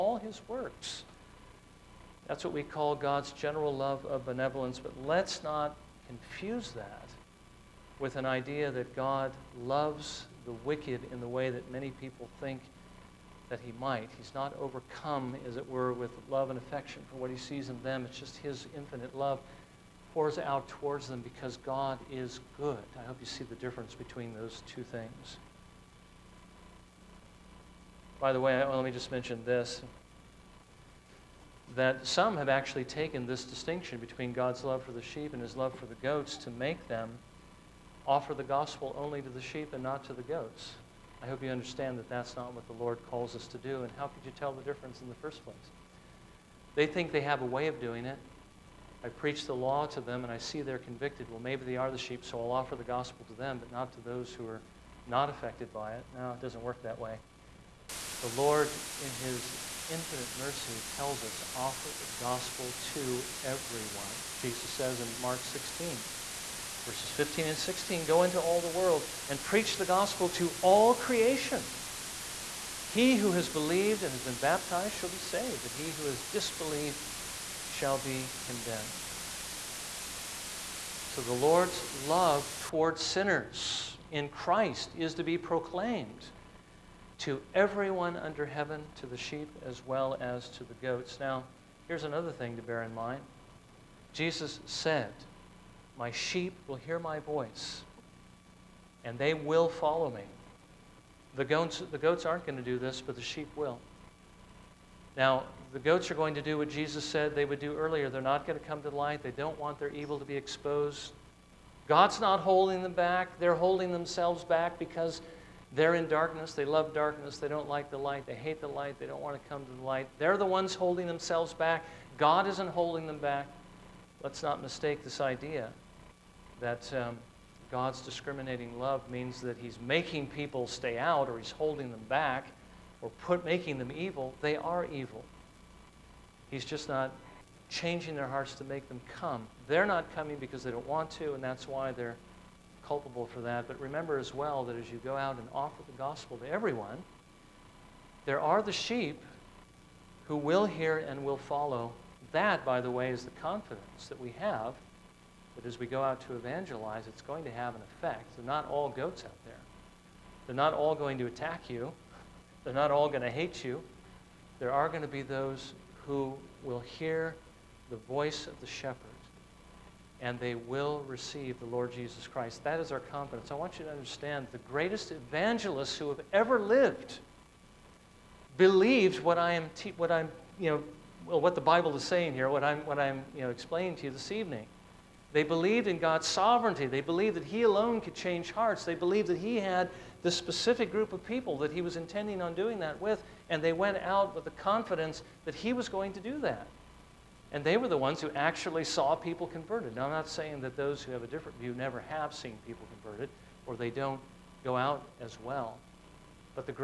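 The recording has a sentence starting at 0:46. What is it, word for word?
They think they have a way of doing it.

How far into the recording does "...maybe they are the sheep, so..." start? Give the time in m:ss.
0:51.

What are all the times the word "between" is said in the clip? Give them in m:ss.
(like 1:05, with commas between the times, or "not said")
0:23, 0:33.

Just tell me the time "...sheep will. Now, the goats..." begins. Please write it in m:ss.
1:43.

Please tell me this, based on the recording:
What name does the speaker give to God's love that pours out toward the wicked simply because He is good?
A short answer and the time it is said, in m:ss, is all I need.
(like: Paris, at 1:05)
General love of benevolence, at 0:03.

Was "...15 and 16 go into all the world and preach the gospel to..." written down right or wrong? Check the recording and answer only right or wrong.
right.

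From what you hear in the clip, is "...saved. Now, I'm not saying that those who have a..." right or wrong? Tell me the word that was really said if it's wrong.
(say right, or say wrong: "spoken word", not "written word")
wrong: "converted", not "saved".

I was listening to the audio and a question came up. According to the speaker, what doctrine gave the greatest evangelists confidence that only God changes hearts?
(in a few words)
God's sovereignty.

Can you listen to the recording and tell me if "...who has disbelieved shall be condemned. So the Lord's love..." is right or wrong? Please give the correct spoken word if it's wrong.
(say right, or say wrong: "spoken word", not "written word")
right.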